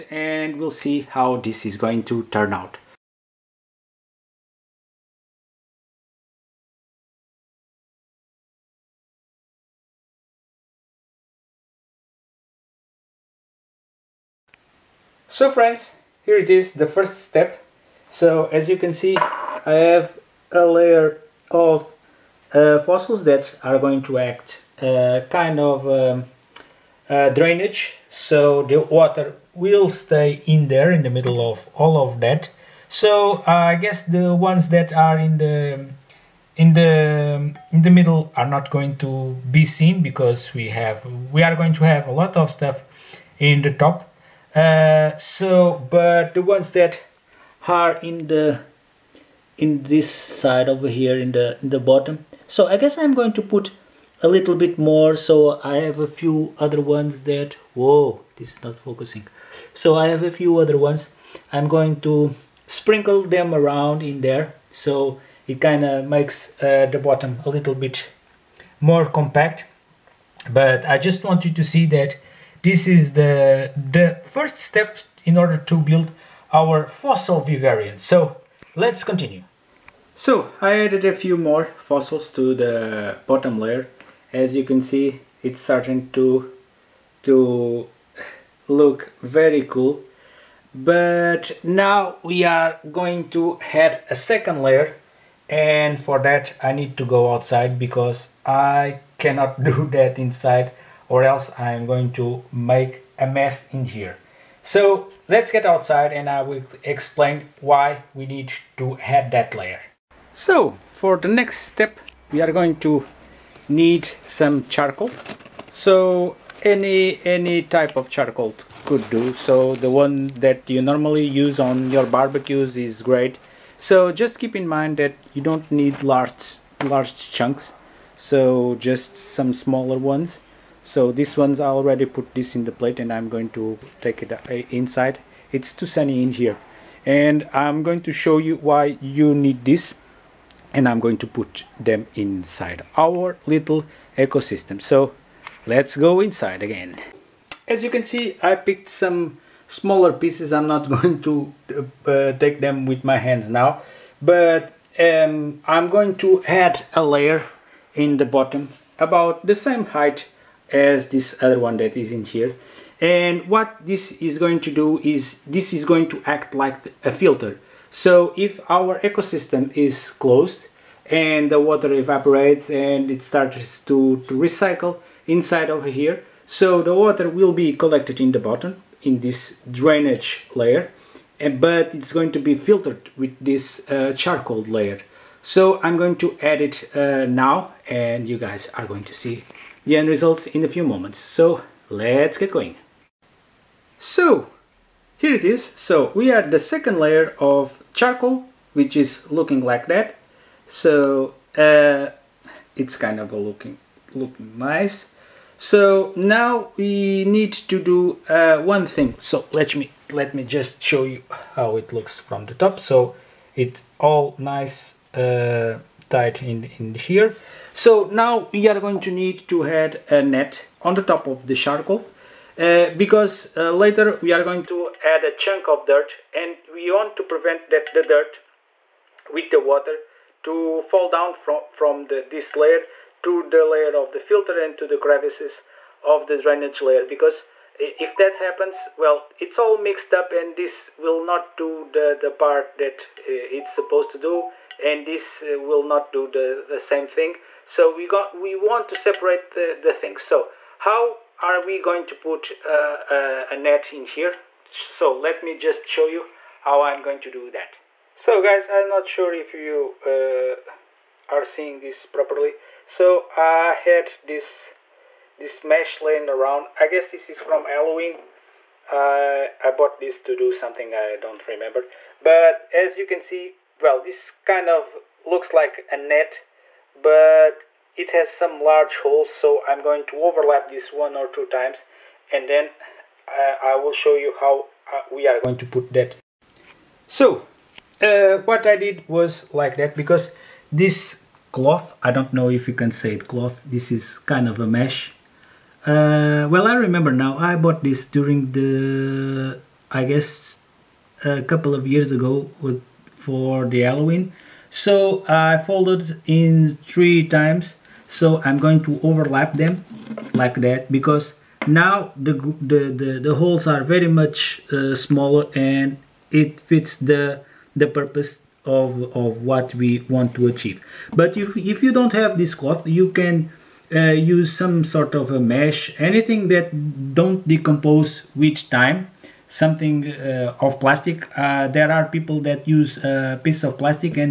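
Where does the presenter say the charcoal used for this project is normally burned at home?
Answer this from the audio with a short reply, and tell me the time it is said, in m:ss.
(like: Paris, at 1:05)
barbecues, at 2:02.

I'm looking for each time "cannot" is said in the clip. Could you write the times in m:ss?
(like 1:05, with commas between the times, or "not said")
1:39.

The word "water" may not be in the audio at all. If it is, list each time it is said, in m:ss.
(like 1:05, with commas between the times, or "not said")
0:28, 2:51, 2:56, 3:49.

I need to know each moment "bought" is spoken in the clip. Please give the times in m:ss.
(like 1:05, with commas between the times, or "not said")
4:29, 4:57.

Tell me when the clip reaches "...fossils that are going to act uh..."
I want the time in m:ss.
0:22.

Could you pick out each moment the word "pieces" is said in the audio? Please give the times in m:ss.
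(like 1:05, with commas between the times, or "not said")
2:30, 5:33.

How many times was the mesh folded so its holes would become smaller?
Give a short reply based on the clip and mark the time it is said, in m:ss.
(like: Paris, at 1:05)
3, at 5:06.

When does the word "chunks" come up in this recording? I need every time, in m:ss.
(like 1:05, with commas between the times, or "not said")
2:07, 3:45.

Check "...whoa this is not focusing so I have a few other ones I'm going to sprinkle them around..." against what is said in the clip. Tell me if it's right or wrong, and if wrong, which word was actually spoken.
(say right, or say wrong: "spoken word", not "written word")
right.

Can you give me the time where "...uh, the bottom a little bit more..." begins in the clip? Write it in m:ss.
1:06.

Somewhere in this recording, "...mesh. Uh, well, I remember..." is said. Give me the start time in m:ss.
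4:54.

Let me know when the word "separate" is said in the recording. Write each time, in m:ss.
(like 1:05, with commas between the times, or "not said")
4:08.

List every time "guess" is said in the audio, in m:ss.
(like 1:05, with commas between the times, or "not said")
0:33, 0:52, 4:26, 5:00.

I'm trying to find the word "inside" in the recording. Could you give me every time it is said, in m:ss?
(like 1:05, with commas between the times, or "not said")
1:40, 2:14, 2:22, 2:26, 2:55.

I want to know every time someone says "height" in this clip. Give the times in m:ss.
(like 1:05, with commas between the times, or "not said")
2:39.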